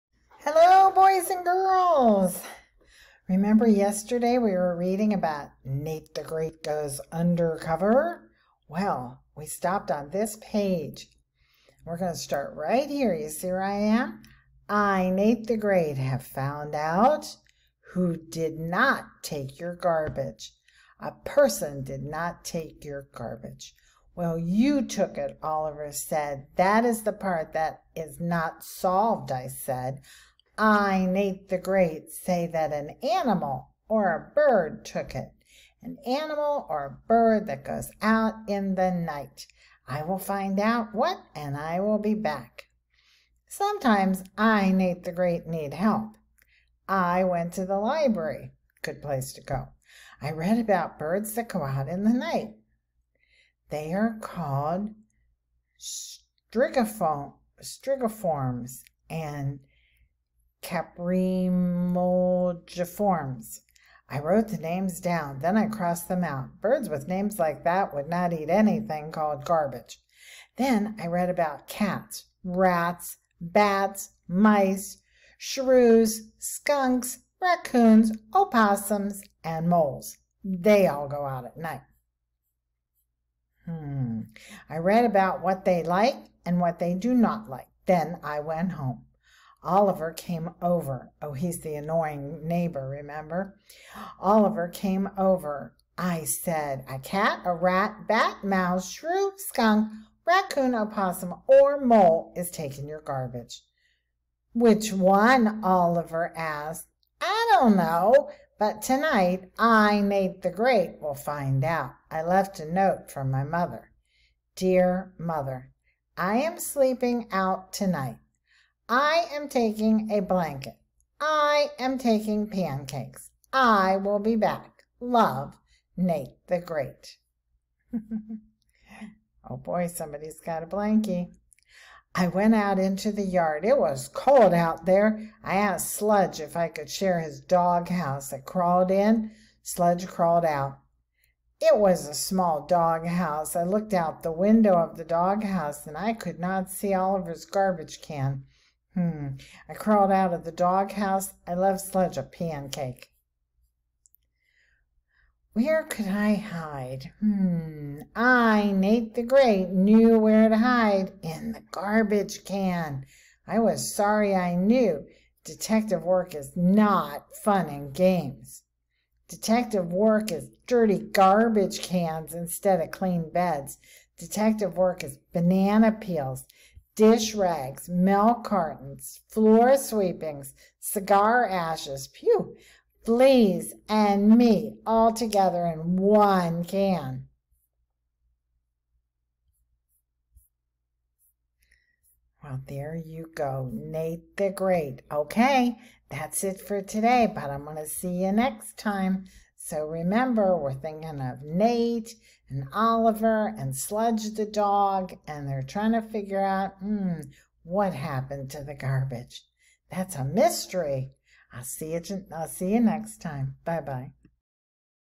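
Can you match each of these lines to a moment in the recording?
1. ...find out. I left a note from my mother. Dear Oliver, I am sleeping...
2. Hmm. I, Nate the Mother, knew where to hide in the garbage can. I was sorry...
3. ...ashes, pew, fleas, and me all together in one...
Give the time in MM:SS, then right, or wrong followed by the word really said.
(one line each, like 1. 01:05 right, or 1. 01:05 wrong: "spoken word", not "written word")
1. 01:51 wrong: "Mother", not "Oliver"
2. 02:37 wrong: "Great", not "Mother"
3. 03:01 right.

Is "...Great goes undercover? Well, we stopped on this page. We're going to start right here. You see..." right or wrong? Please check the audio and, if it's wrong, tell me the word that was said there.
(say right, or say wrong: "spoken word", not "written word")
right.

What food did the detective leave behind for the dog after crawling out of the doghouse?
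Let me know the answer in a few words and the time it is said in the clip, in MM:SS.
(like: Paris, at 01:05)
A pancake, at 02:32.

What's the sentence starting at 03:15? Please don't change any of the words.
Okay, that's it for today, but I'm going to see you next time.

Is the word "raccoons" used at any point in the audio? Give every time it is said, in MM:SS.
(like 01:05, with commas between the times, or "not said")
01:17, 01:40.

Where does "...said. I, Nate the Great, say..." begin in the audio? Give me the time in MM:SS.
00:29.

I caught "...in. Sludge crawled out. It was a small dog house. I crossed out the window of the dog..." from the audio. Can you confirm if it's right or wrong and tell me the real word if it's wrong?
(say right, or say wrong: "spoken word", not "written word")
wrong: "looked", not "crossed".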